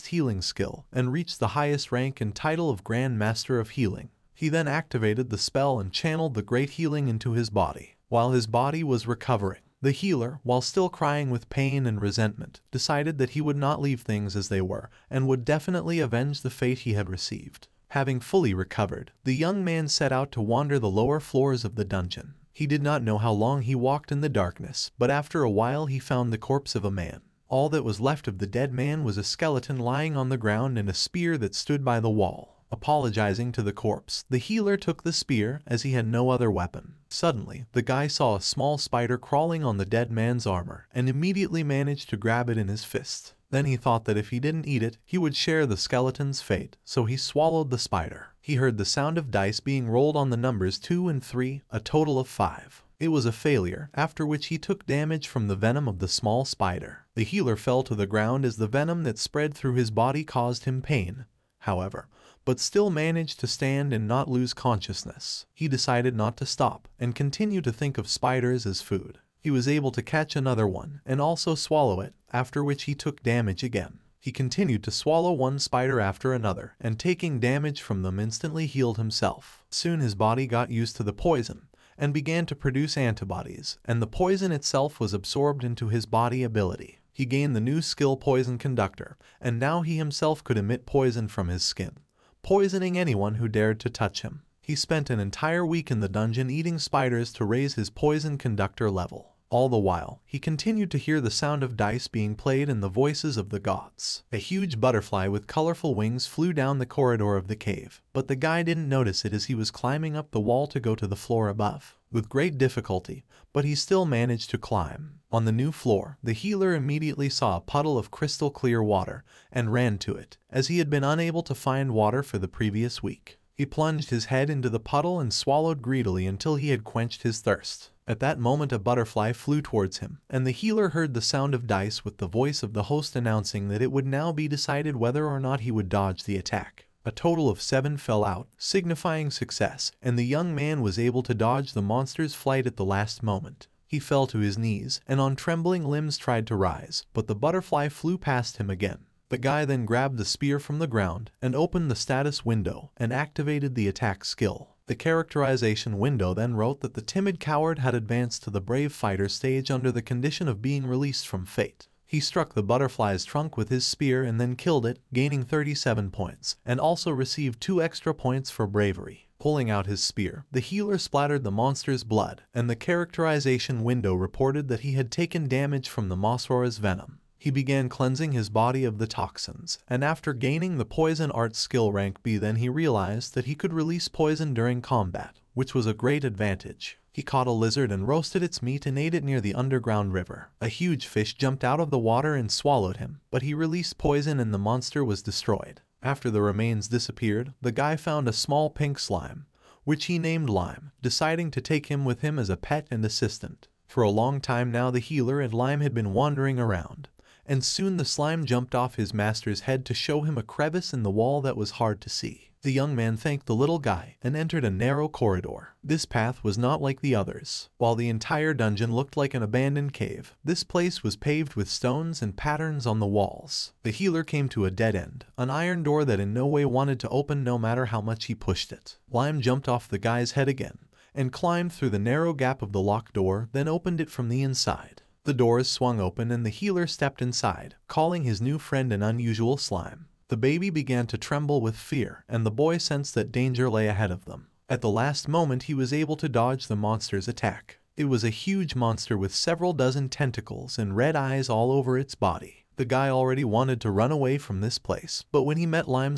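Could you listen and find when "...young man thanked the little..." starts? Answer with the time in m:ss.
3:32.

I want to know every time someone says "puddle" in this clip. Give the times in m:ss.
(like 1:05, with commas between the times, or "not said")
1:57, 2:04.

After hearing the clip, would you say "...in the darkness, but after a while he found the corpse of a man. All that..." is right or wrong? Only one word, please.
right.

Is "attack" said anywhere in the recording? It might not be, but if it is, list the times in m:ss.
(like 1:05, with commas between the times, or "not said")
2:16, 2:33, 4:07.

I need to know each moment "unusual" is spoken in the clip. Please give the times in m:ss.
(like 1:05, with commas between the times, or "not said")
3:59.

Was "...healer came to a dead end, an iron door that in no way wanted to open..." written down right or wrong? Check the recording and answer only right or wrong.
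right.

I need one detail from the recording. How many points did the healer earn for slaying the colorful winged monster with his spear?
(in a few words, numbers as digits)
37.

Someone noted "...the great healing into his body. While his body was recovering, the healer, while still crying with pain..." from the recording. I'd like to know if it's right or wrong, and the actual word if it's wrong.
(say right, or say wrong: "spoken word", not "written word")
right.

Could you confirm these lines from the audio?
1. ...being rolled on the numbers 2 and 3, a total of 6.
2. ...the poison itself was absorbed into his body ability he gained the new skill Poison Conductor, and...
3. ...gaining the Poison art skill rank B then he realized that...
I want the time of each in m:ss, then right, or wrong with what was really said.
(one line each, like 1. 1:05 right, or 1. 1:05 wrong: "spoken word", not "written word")
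1. 0:49 wrong: "5", not "6"
2. 1:23 right
3. 3:00 right.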